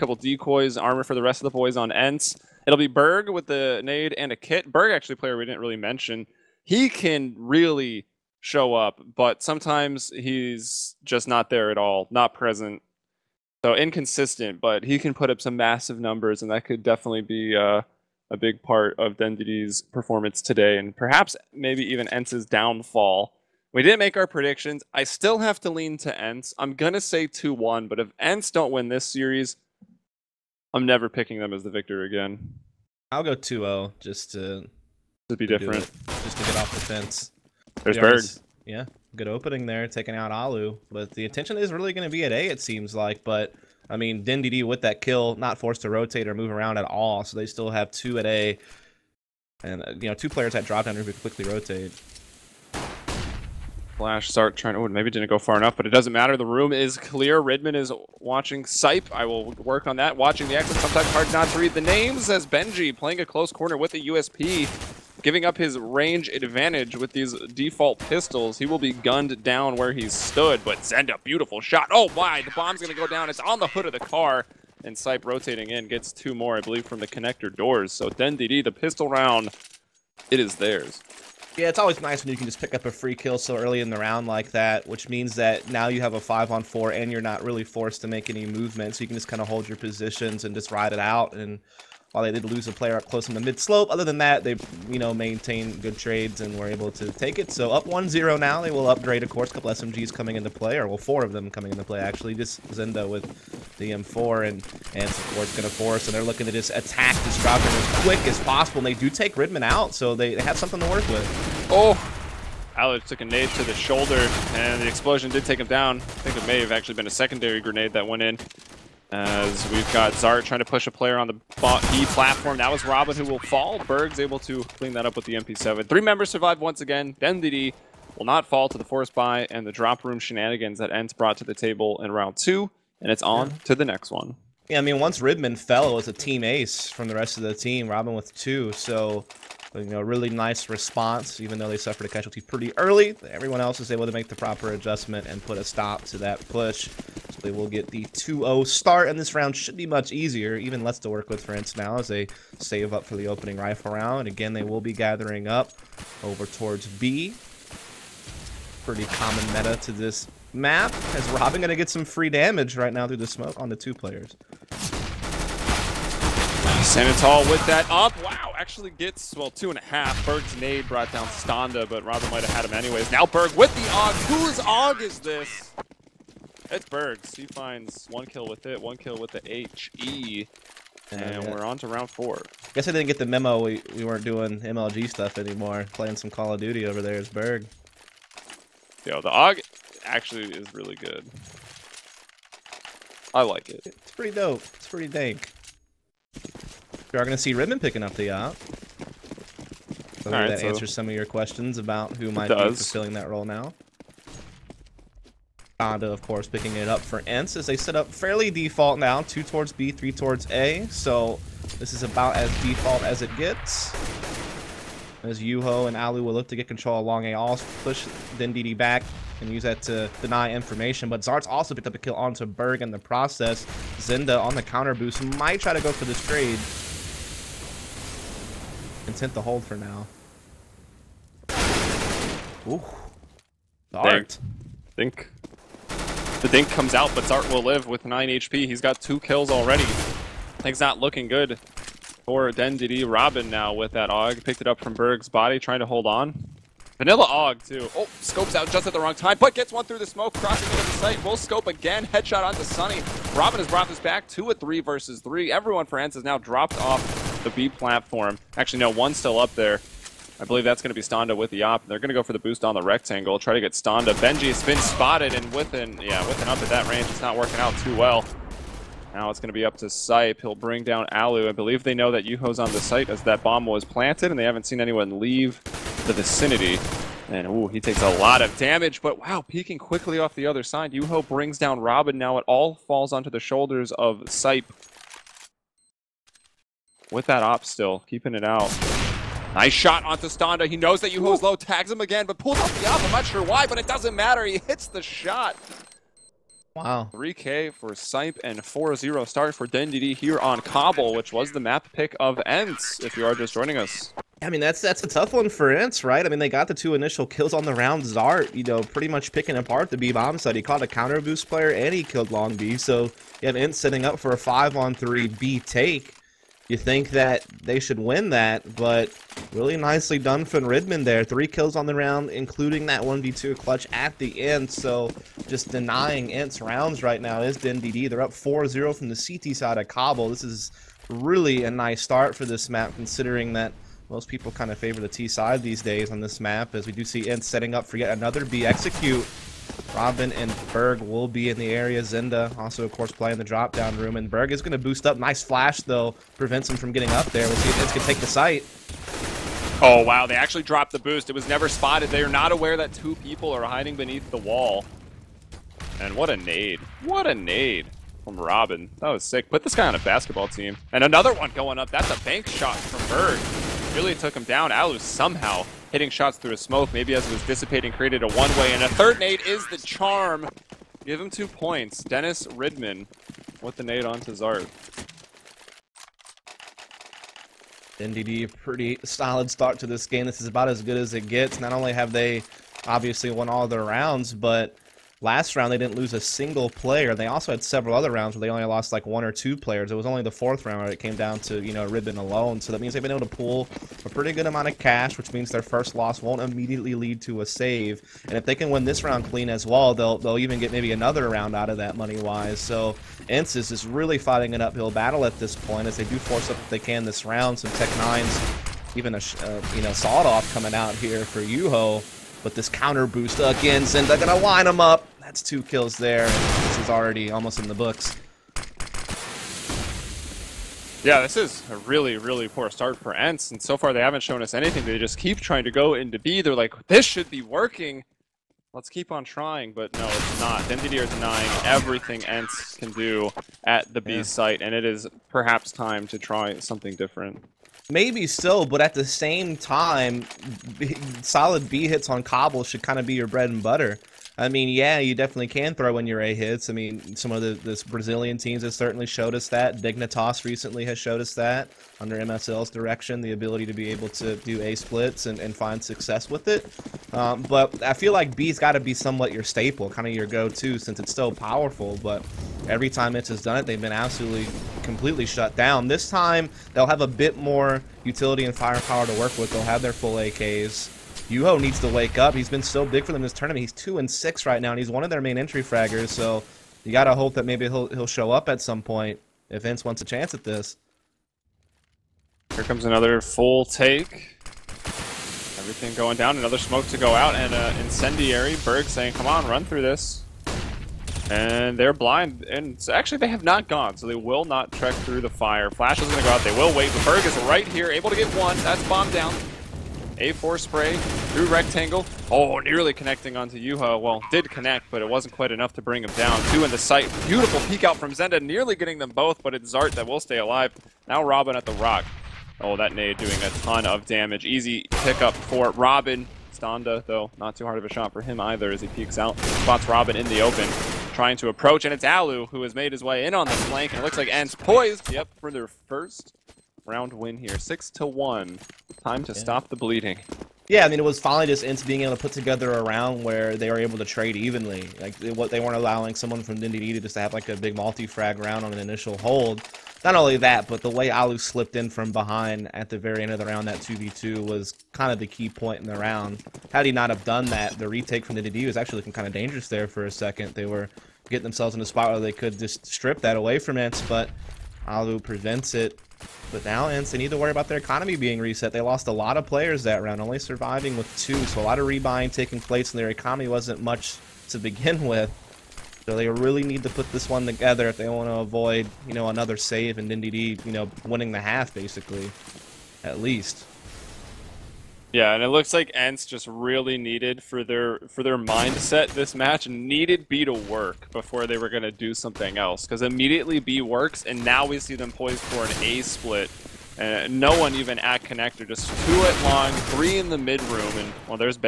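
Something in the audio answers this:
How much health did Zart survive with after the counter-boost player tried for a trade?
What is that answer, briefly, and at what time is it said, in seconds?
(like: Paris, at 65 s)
9 HP, at 238 s.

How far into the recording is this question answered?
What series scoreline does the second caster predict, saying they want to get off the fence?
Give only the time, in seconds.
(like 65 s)
33 s.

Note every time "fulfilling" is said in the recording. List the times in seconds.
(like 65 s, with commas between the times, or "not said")
202 s.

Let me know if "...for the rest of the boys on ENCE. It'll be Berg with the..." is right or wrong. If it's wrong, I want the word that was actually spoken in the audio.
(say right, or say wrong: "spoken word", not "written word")
right.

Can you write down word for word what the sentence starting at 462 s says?
But every time it's has done it, they've been absolutely completely shut down.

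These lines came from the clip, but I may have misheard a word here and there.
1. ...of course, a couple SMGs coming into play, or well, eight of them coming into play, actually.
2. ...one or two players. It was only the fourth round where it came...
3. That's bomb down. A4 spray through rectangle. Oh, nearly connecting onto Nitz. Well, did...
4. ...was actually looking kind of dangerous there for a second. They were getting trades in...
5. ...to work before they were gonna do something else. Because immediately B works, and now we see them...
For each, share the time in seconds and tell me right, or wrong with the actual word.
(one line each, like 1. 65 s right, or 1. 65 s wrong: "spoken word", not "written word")
1. 99 s wrong: "four", not "eight"
2. 389 s right
3. 498 s wrong: "Yuho", not "Nitz"
4. 548 s wrong: "themselves", not "trades"
5. 580 s right.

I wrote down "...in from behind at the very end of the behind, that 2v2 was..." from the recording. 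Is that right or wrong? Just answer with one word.
wrong.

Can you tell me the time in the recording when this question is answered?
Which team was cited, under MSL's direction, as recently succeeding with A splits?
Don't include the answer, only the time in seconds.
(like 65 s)
449 s.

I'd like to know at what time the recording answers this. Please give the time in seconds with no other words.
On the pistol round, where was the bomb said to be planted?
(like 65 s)
73 s.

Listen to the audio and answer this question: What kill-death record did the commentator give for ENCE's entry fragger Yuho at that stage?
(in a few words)
2 and 6.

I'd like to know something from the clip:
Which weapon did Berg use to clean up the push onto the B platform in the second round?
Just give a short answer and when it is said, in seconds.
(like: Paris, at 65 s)
MP7, at 125 s.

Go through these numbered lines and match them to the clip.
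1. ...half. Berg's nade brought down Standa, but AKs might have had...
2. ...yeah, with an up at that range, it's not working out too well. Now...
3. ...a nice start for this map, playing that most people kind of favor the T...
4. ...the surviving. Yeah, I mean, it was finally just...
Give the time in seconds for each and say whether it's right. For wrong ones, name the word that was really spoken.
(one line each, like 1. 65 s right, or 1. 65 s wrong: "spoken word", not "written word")
1. 169 s wrong: "Robin", not "AKs"
2. 266 s right
3. 331 s wrong: "considering", not "playing"
4. 529 s wrong: "bleeding", not "surviving".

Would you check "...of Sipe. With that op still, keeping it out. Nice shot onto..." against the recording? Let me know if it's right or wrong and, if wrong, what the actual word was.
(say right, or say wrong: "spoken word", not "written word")
right.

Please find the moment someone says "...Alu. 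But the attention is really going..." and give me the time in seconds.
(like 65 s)
40 s.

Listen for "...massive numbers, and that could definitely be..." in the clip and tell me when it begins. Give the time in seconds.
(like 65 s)
15 s.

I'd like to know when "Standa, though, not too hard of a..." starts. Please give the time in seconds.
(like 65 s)
516 s.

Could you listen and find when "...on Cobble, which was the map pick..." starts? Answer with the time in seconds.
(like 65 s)
300 s.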